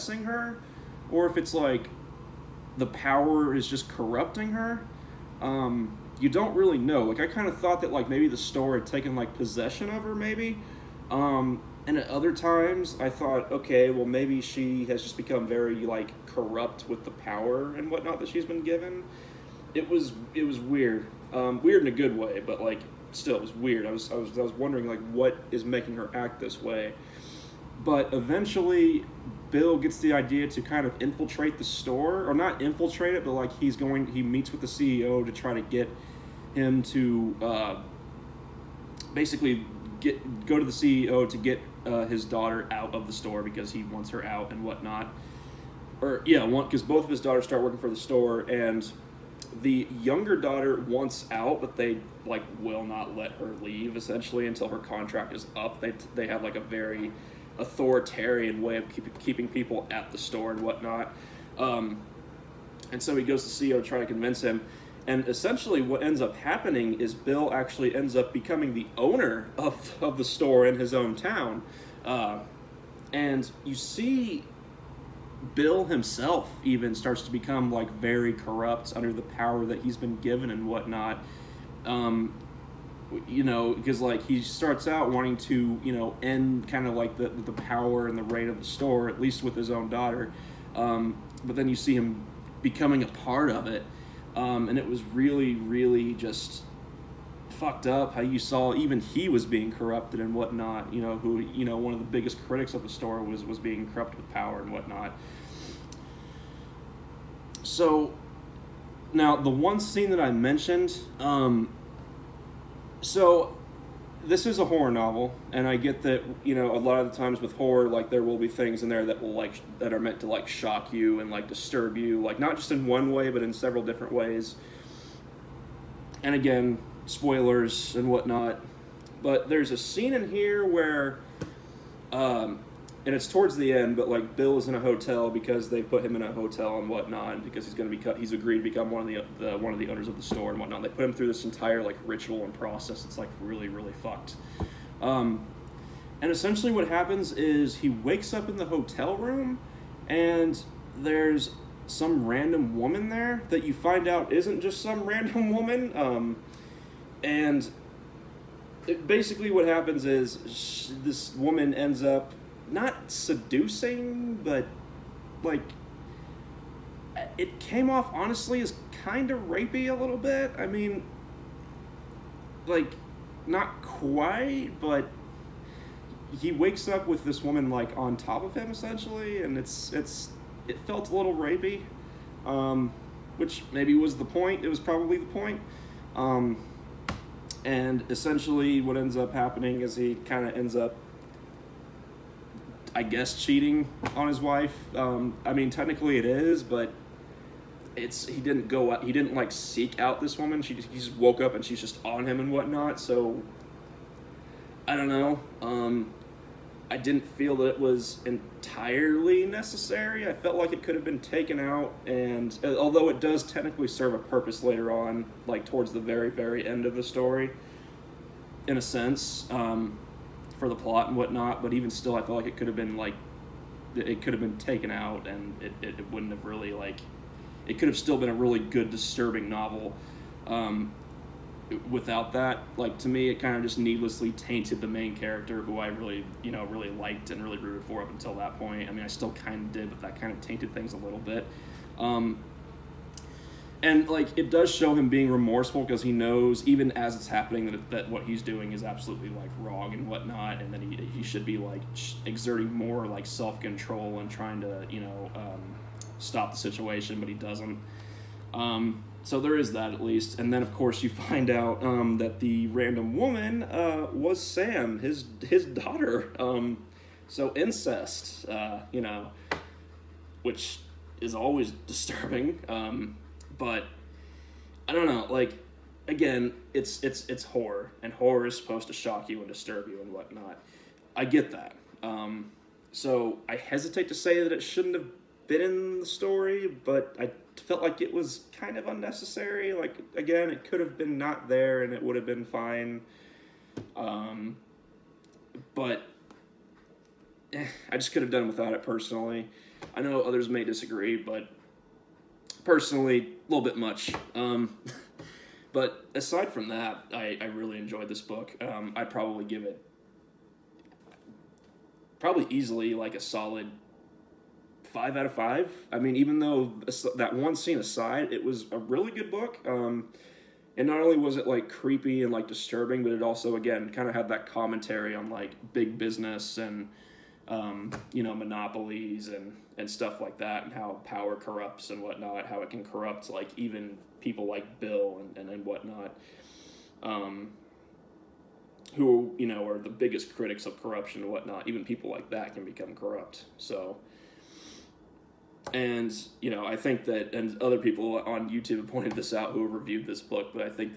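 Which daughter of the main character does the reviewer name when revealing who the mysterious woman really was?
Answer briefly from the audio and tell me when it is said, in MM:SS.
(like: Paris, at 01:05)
Sam, at 04:24.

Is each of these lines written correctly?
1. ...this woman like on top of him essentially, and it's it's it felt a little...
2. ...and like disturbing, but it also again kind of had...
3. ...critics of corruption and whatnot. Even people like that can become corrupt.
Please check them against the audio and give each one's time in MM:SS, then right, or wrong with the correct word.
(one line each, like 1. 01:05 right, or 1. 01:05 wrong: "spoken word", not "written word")
1. 02:57 right
2. 05:22 right
3. 05:40 right.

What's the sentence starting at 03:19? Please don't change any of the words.
He didn't like seek out this woman.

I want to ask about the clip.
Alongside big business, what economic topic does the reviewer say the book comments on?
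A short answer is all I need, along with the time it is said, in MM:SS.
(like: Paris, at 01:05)
monopolies, at 05:28.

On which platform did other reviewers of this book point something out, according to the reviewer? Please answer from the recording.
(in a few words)
YouTube.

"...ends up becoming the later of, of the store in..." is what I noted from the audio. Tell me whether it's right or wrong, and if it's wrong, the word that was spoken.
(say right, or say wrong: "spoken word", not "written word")
wrong: "owner", not "later".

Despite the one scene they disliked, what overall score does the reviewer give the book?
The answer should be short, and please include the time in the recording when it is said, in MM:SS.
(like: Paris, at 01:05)
5 out of 5, at 05:14.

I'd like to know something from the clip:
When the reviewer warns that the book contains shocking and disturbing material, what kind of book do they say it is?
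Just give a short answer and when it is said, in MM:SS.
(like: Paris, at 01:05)
horror novel, at 01:54.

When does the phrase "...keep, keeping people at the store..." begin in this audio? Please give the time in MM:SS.
00:58.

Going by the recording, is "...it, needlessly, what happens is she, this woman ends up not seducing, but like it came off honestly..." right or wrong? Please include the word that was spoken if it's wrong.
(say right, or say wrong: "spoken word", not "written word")
wrong: "basically", not "needlessly".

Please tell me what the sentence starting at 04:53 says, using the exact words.
Um, but eh, I just could have done without it personally.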